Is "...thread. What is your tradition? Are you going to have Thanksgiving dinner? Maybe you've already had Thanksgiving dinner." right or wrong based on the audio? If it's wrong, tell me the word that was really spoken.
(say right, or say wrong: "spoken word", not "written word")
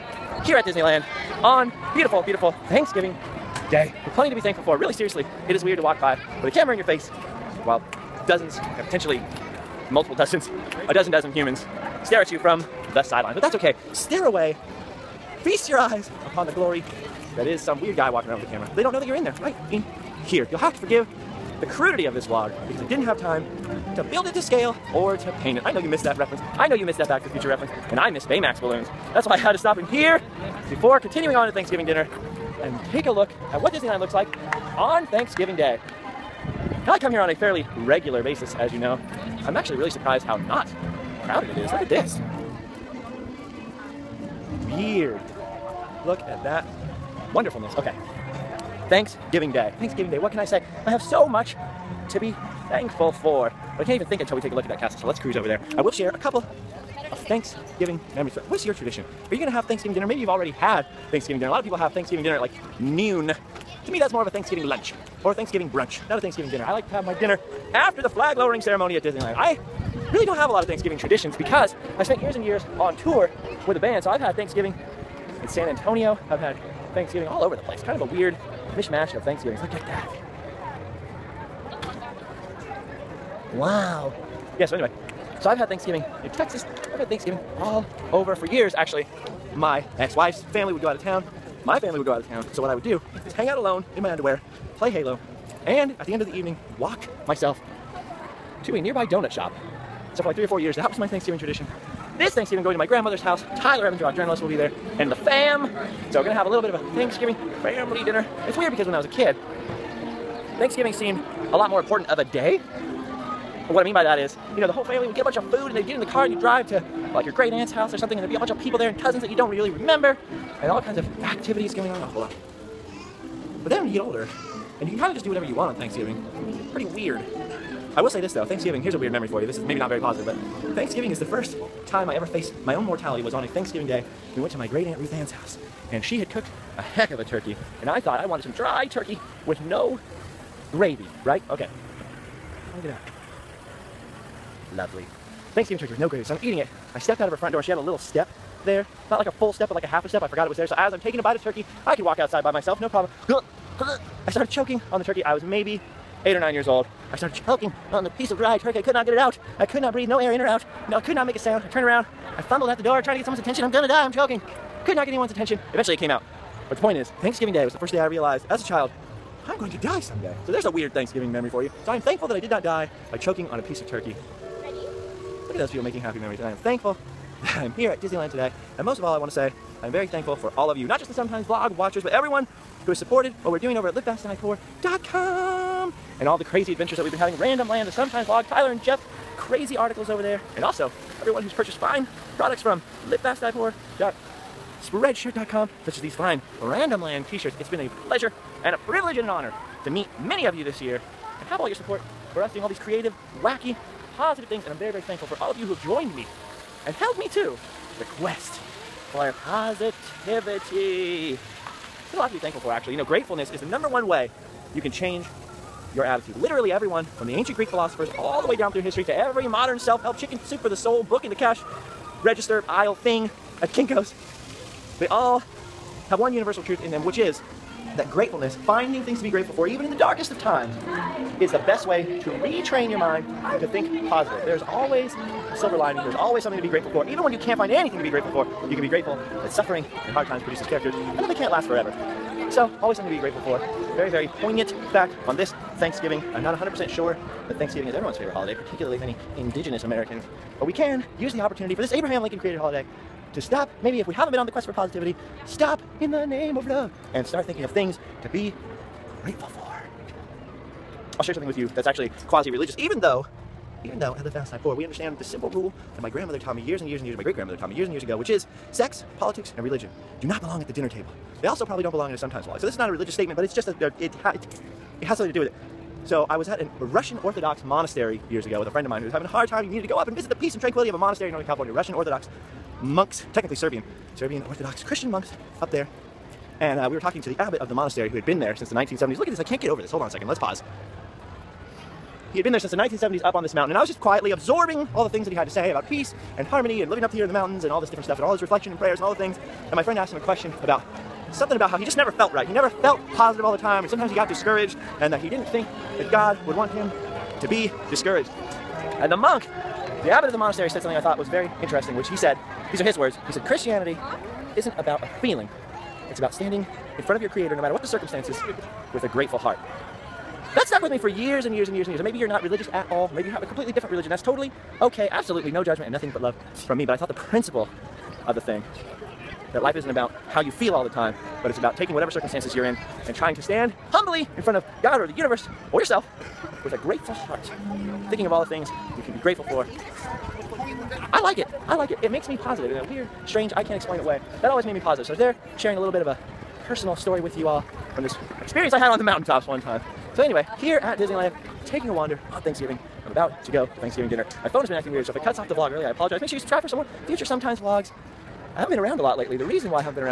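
right.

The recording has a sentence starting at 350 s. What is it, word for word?
So anyway, here at Disneyland, taking a wander on Thanksgiving.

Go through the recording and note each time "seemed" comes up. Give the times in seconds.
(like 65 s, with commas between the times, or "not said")
110 s.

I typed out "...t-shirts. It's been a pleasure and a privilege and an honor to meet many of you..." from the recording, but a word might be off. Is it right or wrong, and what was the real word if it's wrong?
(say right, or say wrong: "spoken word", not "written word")
right.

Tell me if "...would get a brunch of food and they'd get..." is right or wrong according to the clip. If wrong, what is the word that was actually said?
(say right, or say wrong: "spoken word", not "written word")
wrong: "bunch", not "brunch".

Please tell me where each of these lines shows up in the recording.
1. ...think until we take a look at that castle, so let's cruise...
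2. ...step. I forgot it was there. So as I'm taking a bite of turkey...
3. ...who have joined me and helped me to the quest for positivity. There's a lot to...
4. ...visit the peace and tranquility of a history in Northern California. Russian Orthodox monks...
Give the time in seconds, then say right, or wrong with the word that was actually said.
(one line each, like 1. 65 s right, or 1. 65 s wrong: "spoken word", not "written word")
1. 54 s right
2. 150 s right
3. 205 s right
4. 280 s wrong: "monastery", not "history".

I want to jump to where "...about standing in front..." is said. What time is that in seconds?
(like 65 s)
316 s.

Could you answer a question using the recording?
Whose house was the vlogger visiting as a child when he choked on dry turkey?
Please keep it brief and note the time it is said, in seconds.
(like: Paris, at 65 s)
Great aunt Ruth Ann, at 134 s.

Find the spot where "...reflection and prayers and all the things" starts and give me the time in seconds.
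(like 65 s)
298 s.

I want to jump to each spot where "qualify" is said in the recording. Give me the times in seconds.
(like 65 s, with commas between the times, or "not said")
not said.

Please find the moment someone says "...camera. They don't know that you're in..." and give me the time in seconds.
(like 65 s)
18 s.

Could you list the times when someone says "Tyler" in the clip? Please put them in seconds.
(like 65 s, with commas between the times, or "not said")
103 s, 188 s.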